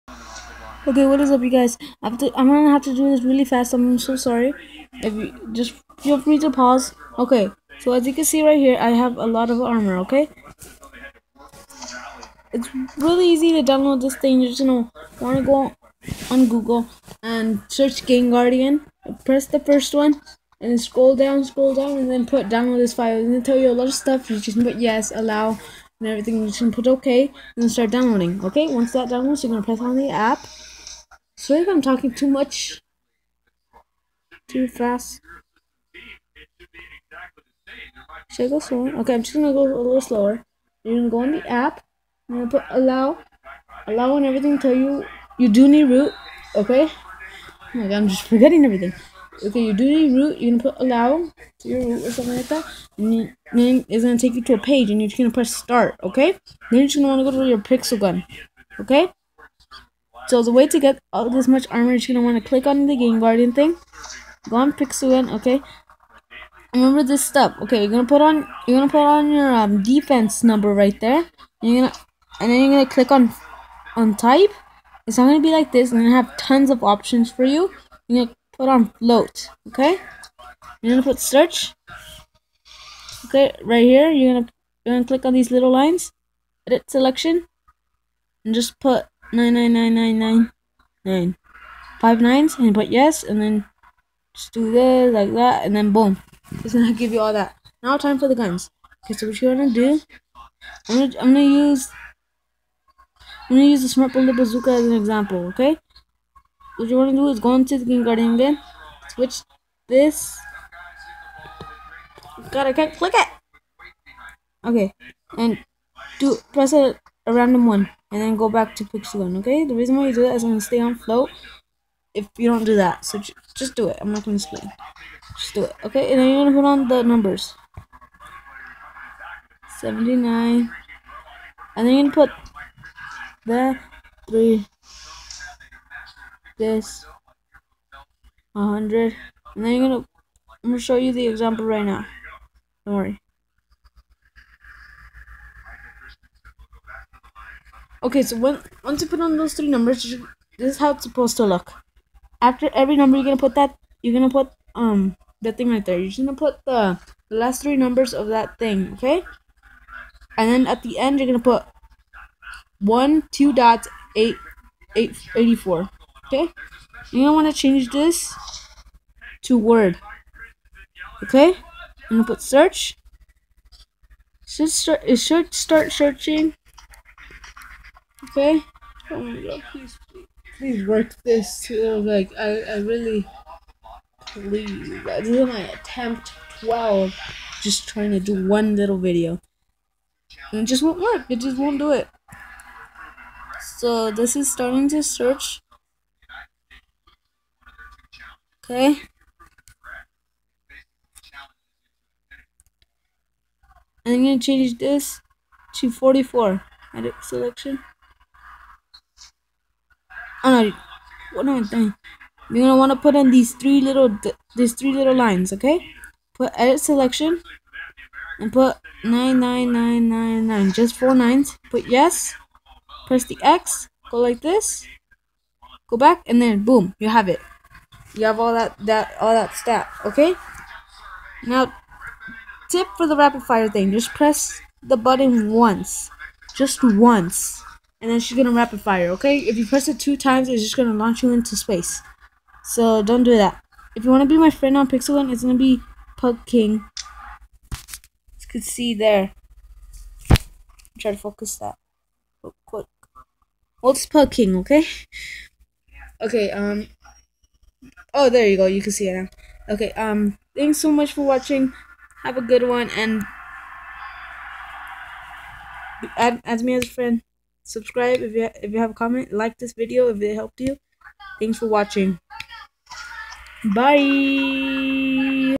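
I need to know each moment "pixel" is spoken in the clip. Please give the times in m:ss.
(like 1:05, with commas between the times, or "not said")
0:57, 1:04, 4:04.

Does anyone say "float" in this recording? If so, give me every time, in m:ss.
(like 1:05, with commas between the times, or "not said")
1:18, 2:00.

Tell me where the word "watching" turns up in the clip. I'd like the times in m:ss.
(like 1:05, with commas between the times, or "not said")
4:21, 4:31.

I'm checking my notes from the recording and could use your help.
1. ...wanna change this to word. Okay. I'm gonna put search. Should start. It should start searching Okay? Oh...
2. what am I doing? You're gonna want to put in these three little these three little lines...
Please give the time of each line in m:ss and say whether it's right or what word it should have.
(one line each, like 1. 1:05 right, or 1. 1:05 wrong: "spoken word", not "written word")
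1. 2:47 right
2. 3:31 right.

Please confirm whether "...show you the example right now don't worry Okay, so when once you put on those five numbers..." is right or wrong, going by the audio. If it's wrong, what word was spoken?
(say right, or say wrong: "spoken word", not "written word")
wrong: "three", not "five".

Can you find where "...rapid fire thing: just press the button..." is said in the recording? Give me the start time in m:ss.
3:53.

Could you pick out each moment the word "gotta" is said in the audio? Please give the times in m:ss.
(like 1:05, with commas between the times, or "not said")
1:52.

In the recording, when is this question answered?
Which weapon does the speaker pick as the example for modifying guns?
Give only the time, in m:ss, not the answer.
1:43.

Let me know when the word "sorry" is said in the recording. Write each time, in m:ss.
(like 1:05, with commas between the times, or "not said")
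0:04, 0:31.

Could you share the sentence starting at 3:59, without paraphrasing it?
If you press it two times, it's just gonna launch you into space.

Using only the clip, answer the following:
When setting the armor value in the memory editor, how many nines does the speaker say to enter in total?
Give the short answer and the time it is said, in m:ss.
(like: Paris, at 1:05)
5, at 1:32.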